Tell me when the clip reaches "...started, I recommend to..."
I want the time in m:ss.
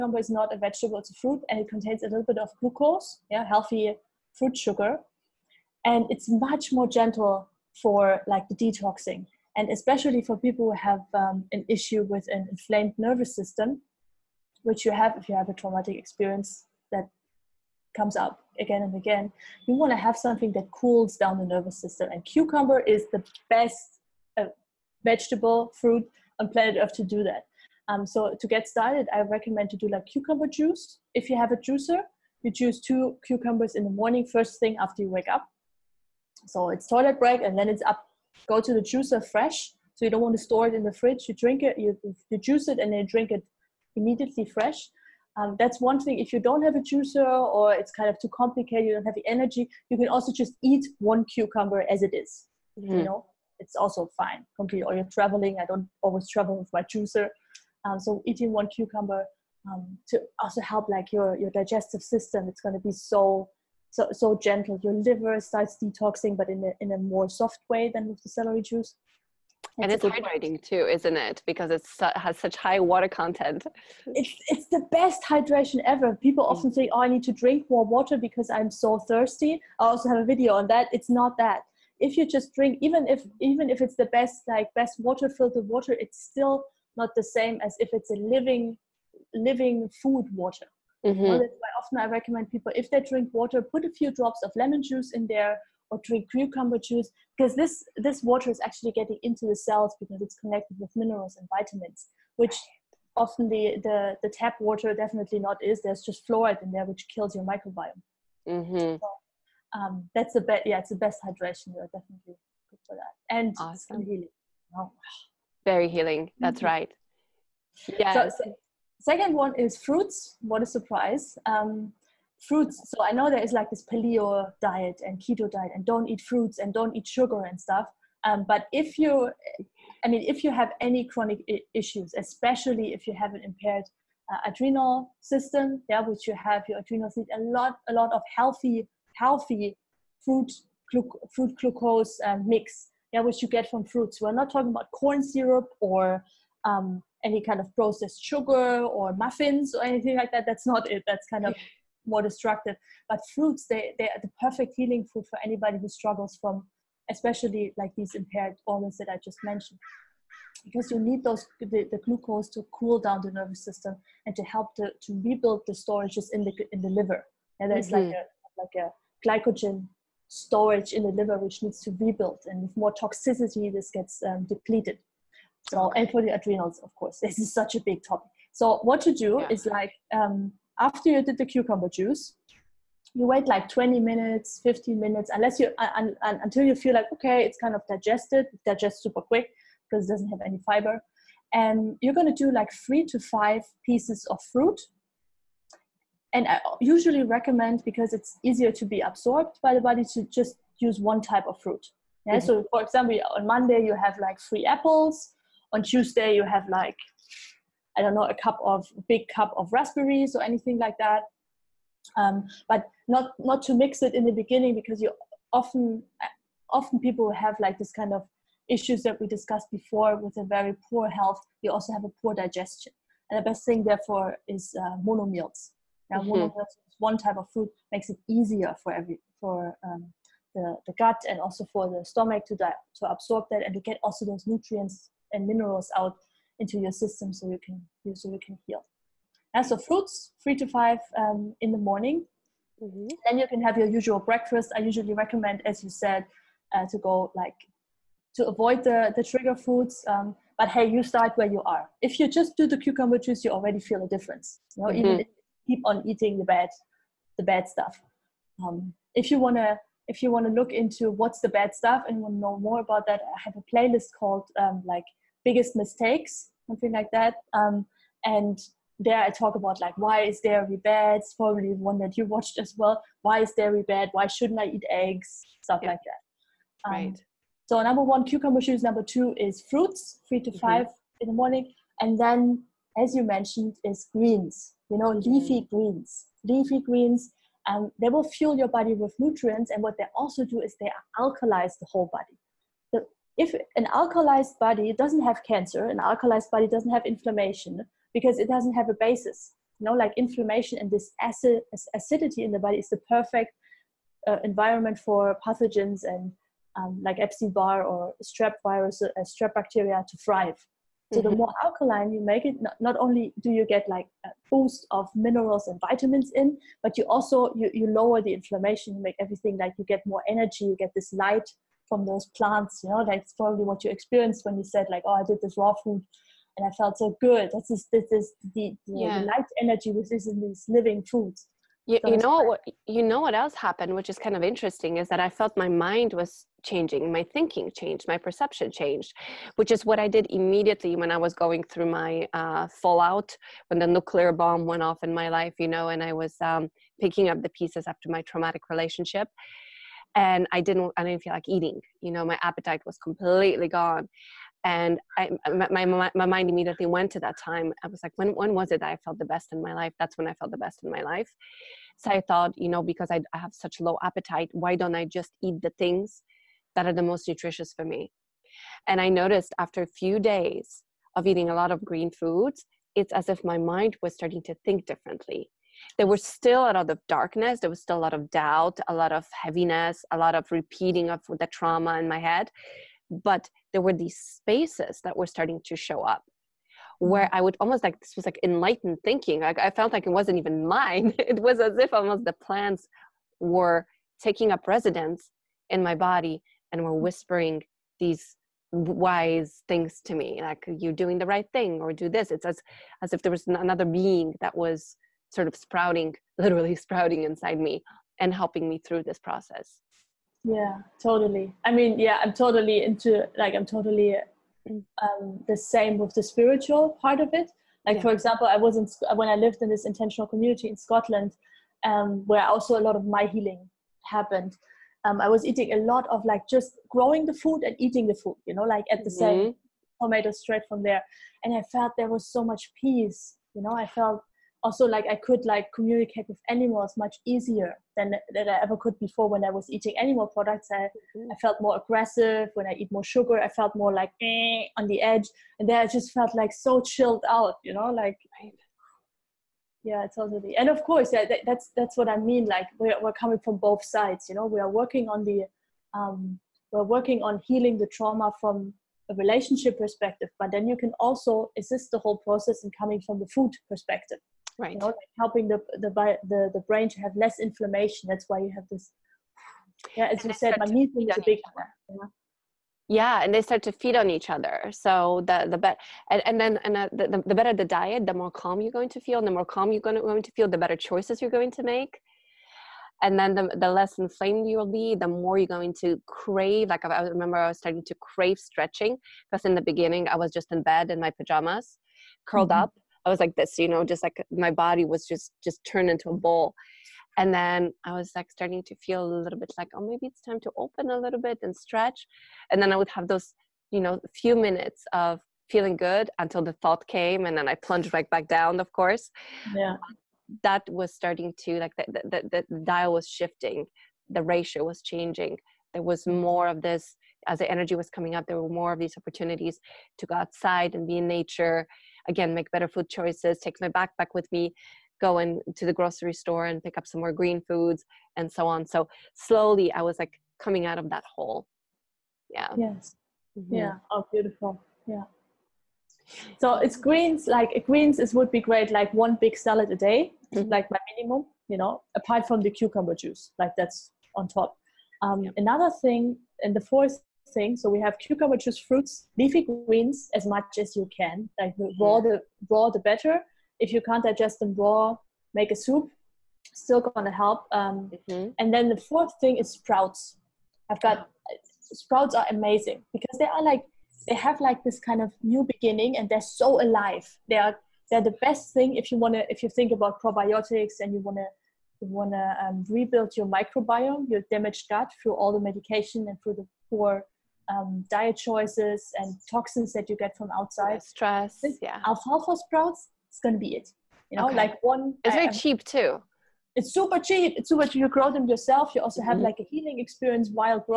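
0:28.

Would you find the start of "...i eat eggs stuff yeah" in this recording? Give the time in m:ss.
4:34.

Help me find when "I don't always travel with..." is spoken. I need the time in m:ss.
0:55.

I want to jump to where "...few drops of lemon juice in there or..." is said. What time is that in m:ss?
1:33.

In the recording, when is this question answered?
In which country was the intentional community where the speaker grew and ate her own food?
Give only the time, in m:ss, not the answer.
7:00.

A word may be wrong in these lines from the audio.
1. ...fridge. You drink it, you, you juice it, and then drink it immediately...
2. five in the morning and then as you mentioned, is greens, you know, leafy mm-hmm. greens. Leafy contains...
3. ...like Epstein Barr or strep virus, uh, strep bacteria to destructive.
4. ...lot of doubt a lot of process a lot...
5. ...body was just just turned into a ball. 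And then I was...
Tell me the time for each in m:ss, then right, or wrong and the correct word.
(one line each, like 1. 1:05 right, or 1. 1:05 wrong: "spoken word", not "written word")
1. 0:40 right
2. 4:40 wrong: "greens", not "contains"
3. 5:07 wrong: "thrive", not "destructive"
4. 6:17 wrong: "heaviness", not "process"
5. 8:14 right.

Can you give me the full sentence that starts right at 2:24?
We're not talking about corn syrup or um, any kind of processed sugar or muffins or anything like that.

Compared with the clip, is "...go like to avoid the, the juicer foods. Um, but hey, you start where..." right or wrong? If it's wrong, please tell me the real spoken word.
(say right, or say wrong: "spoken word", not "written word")
wrong: "trigger", not "juicer".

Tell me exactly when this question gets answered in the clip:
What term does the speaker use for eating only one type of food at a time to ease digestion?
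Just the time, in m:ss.
3:45.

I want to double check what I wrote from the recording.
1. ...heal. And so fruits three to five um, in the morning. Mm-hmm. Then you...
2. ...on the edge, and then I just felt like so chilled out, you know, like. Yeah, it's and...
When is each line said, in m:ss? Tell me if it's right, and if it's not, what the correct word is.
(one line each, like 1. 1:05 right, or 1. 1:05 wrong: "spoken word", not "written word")
1. 3:58 right
2. 7:24 right.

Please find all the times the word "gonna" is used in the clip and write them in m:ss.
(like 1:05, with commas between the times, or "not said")
9:16, 9:43.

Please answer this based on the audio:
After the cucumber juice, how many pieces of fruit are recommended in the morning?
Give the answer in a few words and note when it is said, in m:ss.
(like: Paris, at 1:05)
3 to 5, at 3:12.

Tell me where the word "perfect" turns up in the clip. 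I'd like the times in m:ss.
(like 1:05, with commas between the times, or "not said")
2:34, 5:03.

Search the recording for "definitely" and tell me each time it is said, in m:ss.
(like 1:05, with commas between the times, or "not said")
1:44, 1:51.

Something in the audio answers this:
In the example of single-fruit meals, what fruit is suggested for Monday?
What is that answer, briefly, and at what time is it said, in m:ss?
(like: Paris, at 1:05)
Apples, at 3:24.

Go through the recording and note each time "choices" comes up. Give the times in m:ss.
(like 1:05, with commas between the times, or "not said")
8:00, 8:42, 9:38.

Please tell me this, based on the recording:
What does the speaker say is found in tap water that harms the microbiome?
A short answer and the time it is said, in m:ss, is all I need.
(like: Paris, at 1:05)
Fluoride, at 1:46.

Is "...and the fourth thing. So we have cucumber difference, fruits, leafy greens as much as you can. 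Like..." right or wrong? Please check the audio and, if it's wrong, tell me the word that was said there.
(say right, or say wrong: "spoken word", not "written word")
wrong: "juice", not "difference".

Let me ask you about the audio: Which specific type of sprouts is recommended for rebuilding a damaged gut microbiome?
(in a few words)
Alfalfa sprouts.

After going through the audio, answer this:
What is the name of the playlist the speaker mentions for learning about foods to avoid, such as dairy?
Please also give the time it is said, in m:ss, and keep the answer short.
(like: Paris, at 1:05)
Biggest mistakes, at 4:25.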